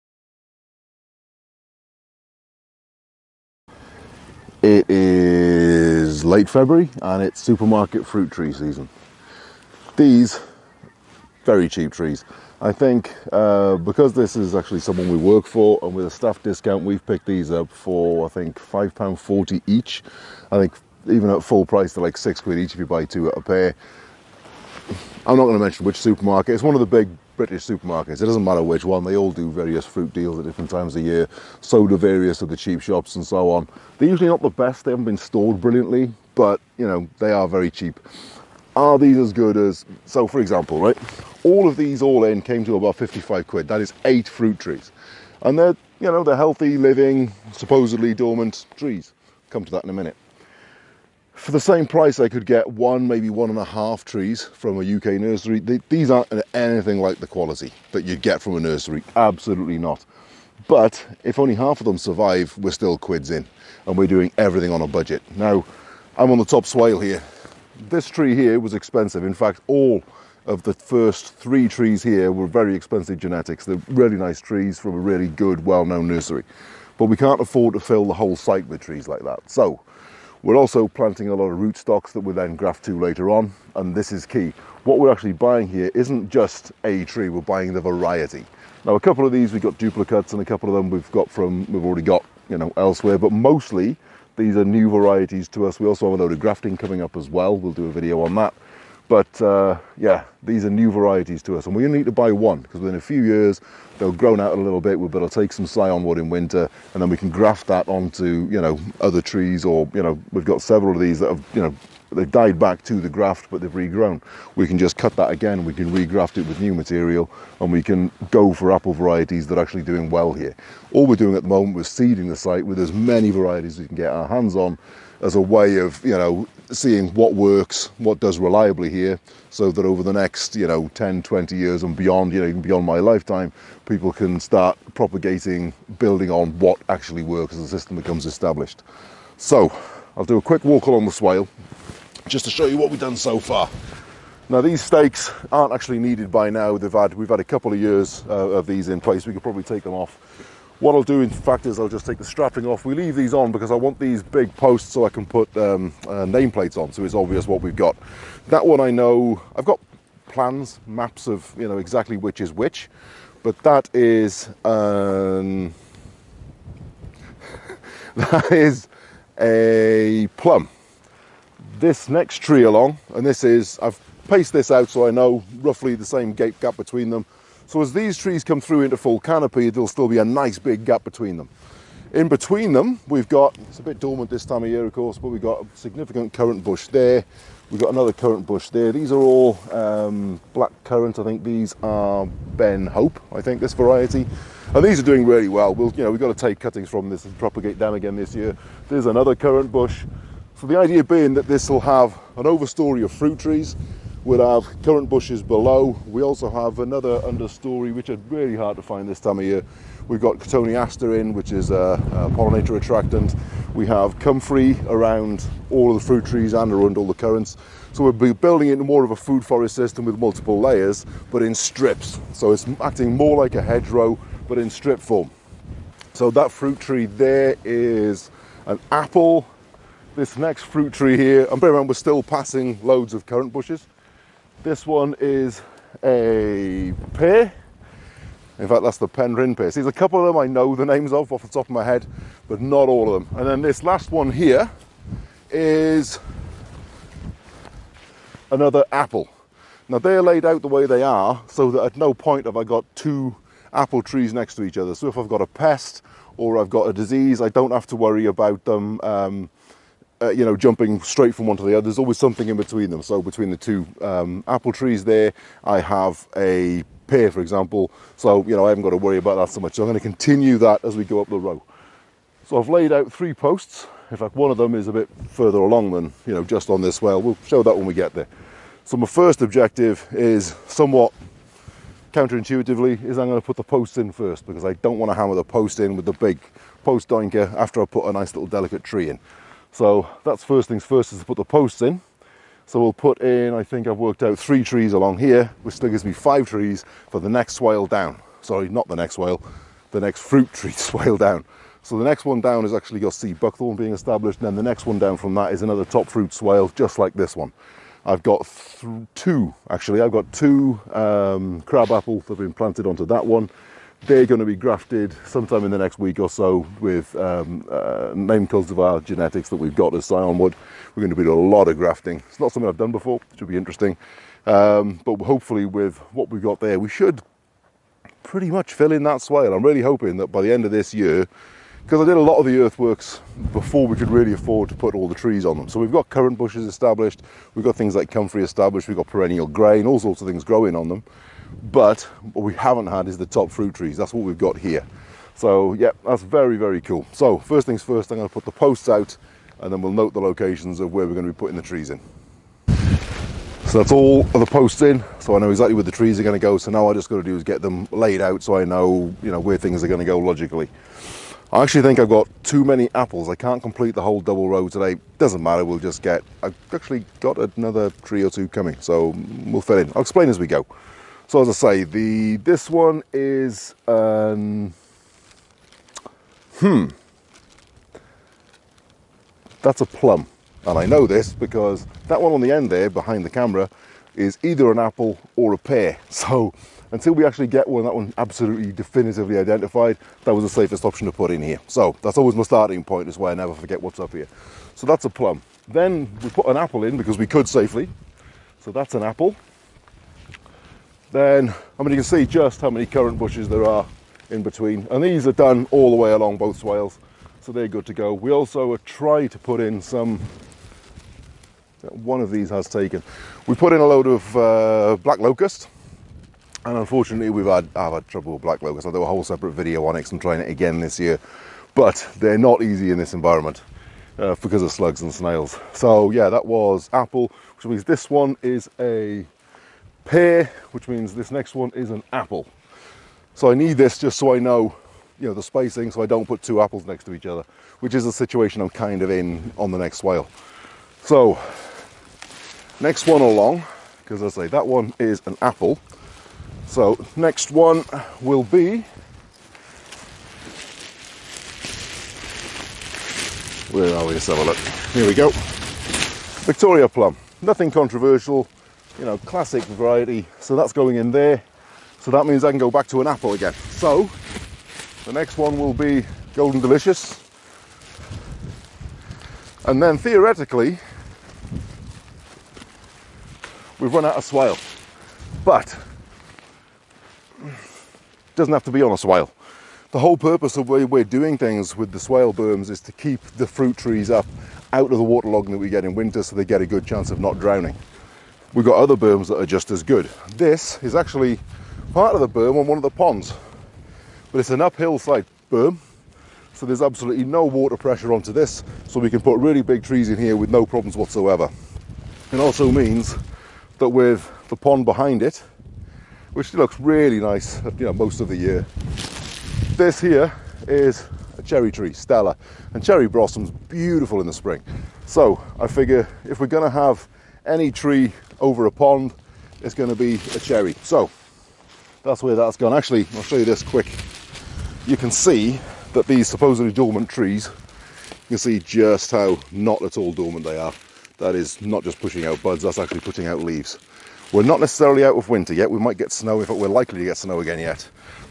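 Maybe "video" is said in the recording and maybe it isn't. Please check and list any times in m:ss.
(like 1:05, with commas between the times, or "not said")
1:37, 6:59.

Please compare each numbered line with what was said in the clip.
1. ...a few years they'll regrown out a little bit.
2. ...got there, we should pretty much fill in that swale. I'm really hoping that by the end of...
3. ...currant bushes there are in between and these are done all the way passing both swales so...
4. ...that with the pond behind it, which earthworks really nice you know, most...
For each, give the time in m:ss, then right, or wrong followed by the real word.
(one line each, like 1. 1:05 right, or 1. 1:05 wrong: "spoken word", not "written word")
1. 1:42 wrong: "grown", not "regrown"
2. 5:26 right
3. 6:42 wrong: "along", not "passing"
4. 8:23 wrong: "looks", not "earthworks".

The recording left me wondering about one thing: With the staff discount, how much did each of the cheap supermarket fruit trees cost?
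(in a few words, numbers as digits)
£5.40.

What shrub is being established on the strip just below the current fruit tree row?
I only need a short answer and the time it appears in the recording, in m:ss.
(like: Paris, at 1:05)
sea buckthorn, at 5:03.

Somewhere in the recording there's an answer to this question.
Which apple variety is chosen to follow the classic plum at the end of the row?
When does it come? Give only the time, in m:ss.
7:46.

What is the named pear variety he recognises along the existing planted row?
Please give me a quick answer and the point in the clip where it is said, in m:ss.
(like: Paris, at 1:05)
Penryn pear, at 3:59.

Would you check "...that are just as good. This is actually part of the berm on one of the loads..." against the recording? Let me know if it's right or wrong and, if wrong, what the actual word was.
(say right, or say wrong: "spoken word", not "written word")
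wrong: "ponds", not "loads".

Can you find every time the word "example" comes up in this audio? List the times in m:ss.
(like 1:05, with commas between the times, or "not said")
0:40, 4:27.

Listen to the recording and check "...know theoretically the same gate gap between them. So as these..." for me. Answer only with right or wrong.
wrong.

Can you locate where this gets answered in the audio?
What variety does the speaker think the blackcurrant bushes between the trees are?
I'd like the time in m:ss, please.
3:12.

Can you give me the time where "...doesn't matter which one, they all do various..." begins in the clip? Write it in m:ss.
0:28.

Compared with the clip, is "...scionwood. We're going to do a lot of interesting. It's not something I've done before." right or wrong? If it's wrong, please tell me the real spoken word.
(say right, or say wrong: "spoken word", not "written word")
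wrong: "grafting", not "interesting".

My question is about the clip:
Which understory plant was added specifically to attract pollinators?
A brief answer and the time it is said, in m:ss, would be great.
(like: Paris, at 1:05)
Cotoneaster, at 3:30.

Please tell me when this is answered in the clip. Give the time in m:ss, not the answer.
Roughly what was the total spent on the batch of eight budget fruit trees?
0:42.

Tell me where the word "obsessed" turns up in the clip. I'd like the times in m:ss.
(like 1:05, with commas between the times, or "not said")
not said.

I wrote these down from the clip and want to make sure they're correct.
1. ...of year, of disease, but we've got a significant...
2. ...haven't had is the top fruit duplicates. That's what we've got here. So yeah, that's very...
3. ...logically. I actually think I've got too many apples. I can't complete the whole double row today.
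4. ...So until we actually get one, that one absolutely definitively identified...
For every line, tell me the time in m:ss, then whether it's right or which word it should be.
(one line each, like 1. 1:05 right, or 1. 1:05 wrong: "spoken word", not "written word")
1. 3:04 wrong: "course", not "disease"
2. 5:42 wrong: "trees", not "duplicates"
3. 6:00 right
4. 6:26 right.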